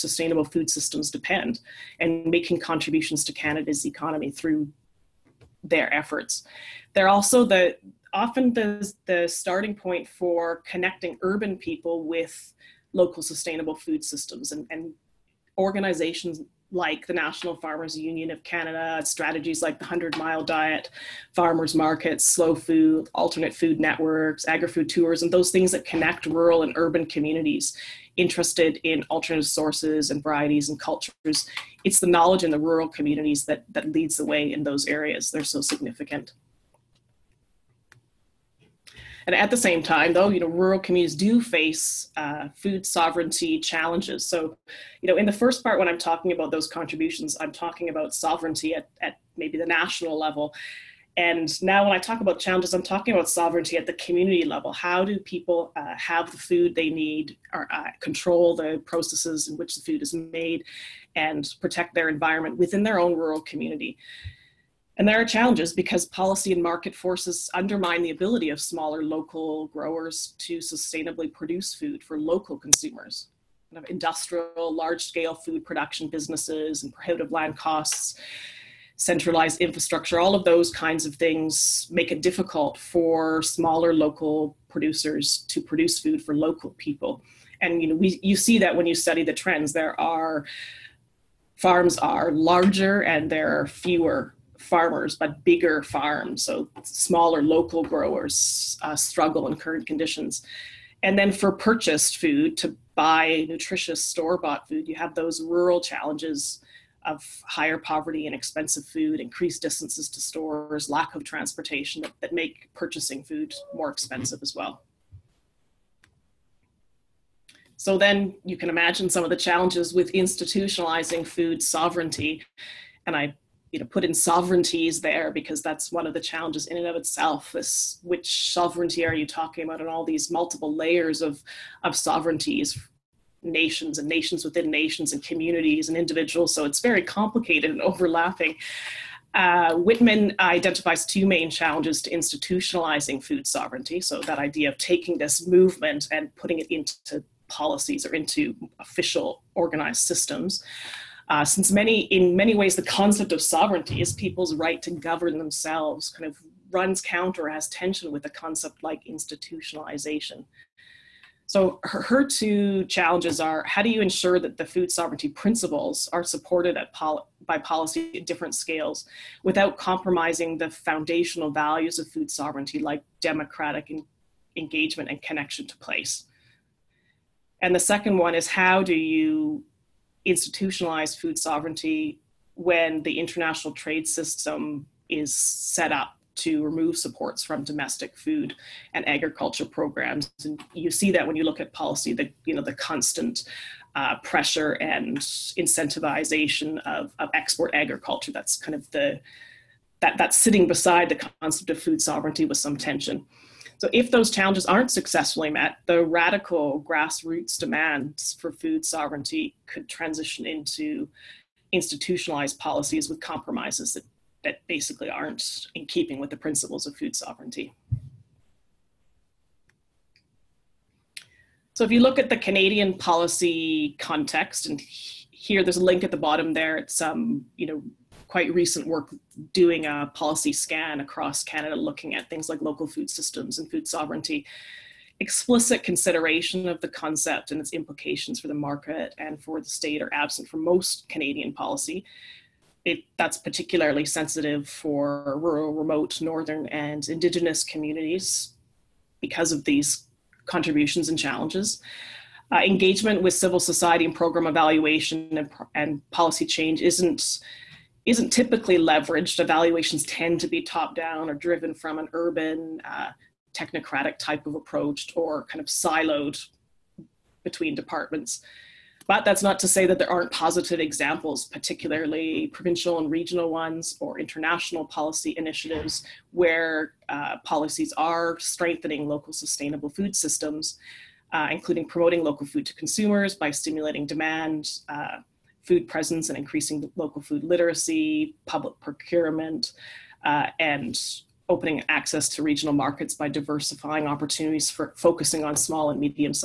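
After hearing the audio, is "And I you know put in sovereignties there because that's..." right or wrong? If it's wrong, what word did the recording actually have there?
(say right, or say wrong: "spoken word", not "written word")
right.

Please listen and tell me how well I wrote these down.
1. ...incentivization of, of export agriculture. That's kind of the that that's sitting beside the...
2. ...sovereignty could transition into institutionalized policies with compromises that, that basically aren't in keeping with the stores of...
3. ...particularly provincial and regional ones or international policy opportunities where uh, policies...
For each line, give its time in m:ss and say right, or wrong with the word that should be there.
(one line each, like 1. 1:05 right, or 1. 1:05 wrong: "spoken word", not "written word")
1. 3:15 right
2. 3:28 wrong: "principles", not "stores"
3. 4:31 wrong: "initiatives", not "opportunities".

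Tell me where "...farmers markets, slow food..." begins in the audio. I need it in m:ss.
0:21.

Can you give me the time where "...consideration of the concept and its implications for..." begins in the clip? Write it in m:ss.
3:55.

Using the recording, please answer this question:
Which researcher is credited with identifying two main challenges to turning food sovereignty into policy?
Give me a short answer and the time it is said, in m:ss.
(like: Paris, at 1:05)
Wittman, at 2:19.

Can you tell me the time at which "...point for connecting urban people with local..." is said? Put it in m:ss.
0:09.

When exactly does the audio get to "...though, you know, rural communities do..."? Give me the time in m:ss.
0:40.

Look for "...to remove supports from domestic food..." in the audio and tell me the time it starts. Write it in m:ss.
3:06.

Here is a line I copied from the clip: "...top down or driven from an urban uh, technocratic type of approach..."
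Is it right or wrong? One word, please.
right.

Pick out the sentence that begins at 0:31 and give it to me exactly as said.
It's the knowledge in the rural communities that, that leads the way in those areas.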